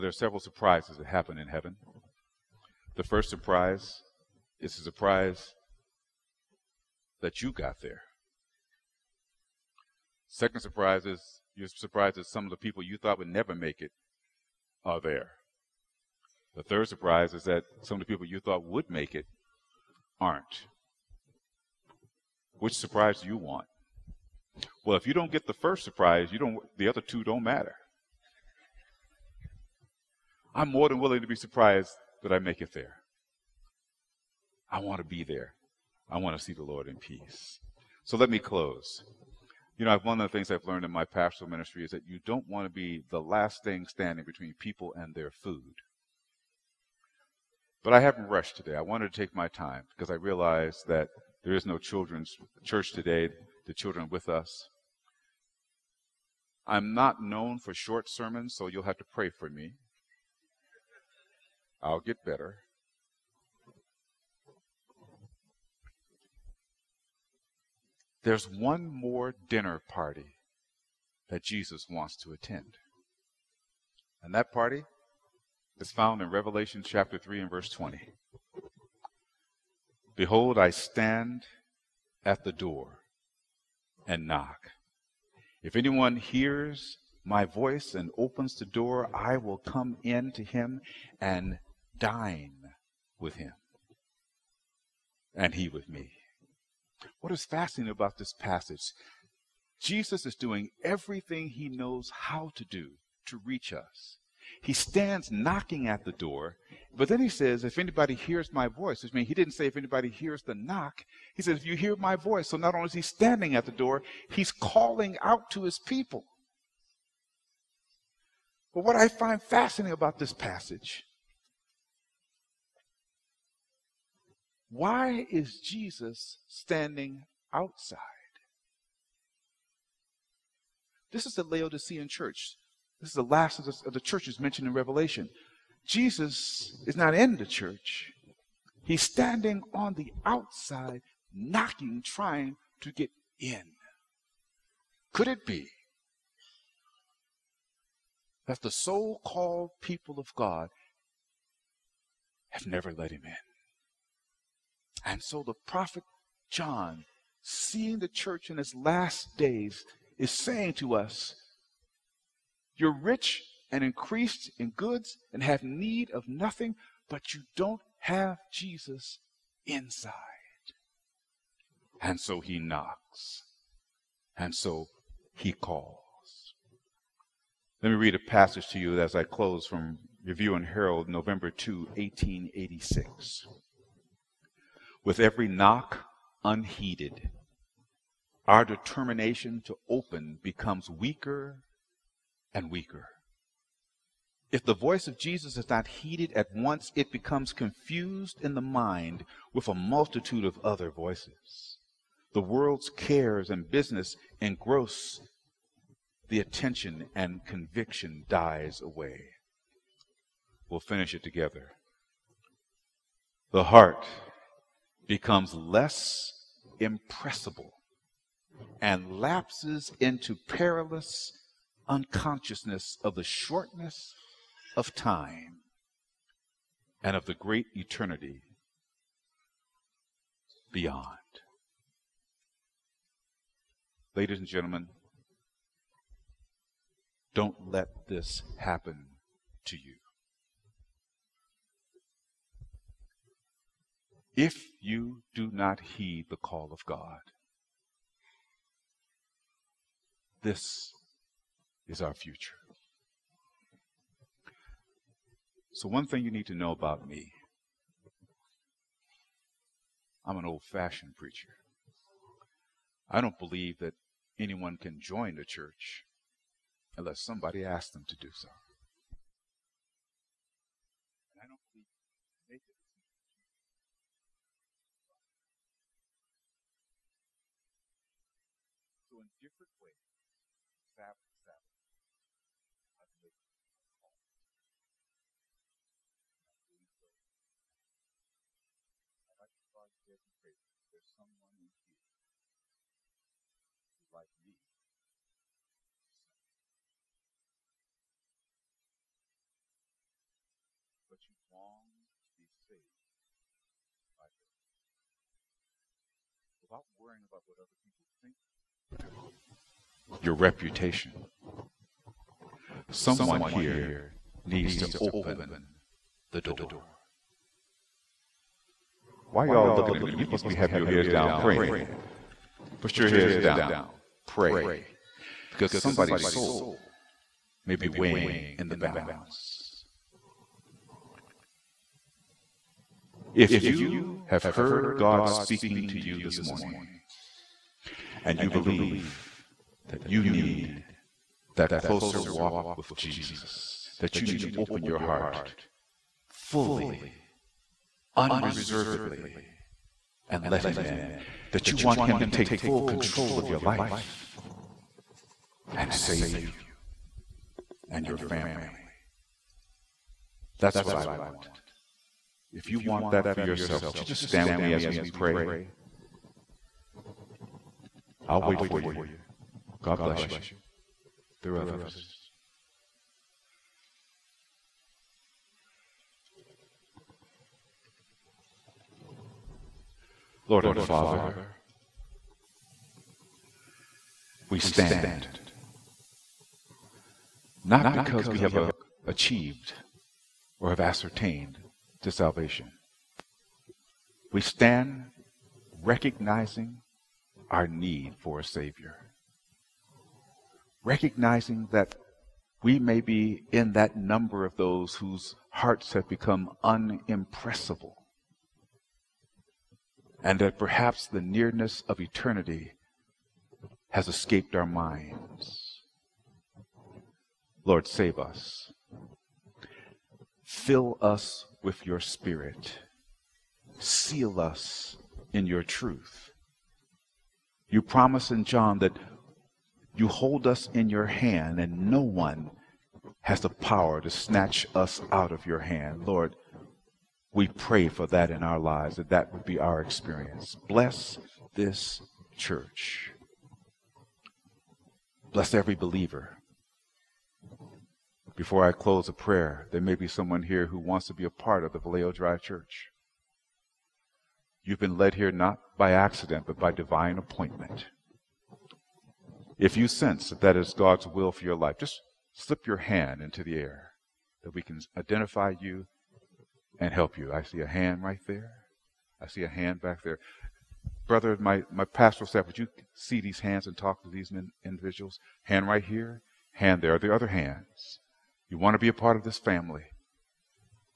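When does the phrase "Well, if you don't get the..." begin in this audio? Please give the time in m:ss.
0:24.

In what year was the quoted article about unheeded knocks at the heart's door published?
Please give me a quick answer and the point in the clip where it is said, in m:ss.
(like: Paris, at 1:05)
1886, at 3:01.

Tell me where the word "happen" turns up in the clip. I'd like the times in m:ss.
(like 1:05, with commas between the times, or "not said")
0:01, 3:58.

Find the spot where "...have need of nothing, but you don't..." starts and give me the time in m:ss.
2:45.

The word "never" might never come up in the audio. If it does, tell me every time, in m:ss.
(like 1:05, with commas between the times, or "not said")
0:13, 2:32.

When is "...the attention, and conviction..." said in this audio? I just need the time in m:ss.
3:26.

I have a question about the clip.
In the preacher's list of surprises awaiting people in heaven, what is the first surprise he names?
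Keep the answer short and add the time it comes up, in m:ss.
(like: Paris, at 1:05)
That you got there, at 0:07.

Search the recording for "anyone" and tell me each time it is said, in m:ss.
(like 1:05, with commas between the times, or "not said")
1:25, 4:24.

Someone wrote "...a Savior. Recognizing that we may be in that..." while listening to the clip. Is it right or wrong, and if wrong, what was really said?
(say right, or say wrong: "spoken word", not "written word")
right.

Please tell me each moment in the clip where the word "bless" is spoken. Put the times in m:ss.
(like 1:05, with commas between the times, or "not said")
6:10, 7:20, 7:25.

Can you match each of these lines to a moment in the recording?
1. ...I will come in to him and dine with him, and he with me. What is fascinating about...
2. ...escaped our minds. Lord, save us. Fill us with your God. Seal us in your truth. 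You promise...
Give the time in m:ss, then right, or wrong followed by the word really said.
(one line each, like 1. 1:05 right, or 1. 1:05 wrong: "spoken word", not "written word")
1. 1:29 right
2. 6:54 wrong: "Spirit", not "God".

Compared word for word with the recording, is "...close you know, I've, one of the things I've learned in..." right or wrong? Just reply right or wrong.
right.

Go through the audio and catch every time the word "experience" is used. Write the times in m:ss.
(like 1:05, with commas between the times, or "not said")
7:19.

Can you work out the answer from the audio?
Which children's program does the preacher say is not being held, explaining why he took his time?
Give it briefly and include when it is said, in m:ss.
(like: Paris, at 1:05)
Children's church, at 0:51.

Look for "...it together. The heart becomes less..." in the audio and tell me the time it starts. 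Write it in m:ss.
3:31.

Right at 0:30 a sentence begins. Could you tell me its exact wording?
I'm more than willing to be surprised that I make it there.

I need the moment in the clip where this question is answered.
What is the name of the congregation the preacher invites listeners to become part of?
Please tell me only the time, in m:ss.
7:31.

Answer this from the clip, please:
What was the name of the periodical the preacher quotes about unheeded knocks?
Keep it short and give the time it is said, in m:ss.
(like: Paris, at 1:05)
Review and Herald, at 3:00.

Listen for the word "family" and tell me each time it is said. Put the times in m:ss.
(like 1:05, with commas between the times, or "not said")
5:58, 7:59.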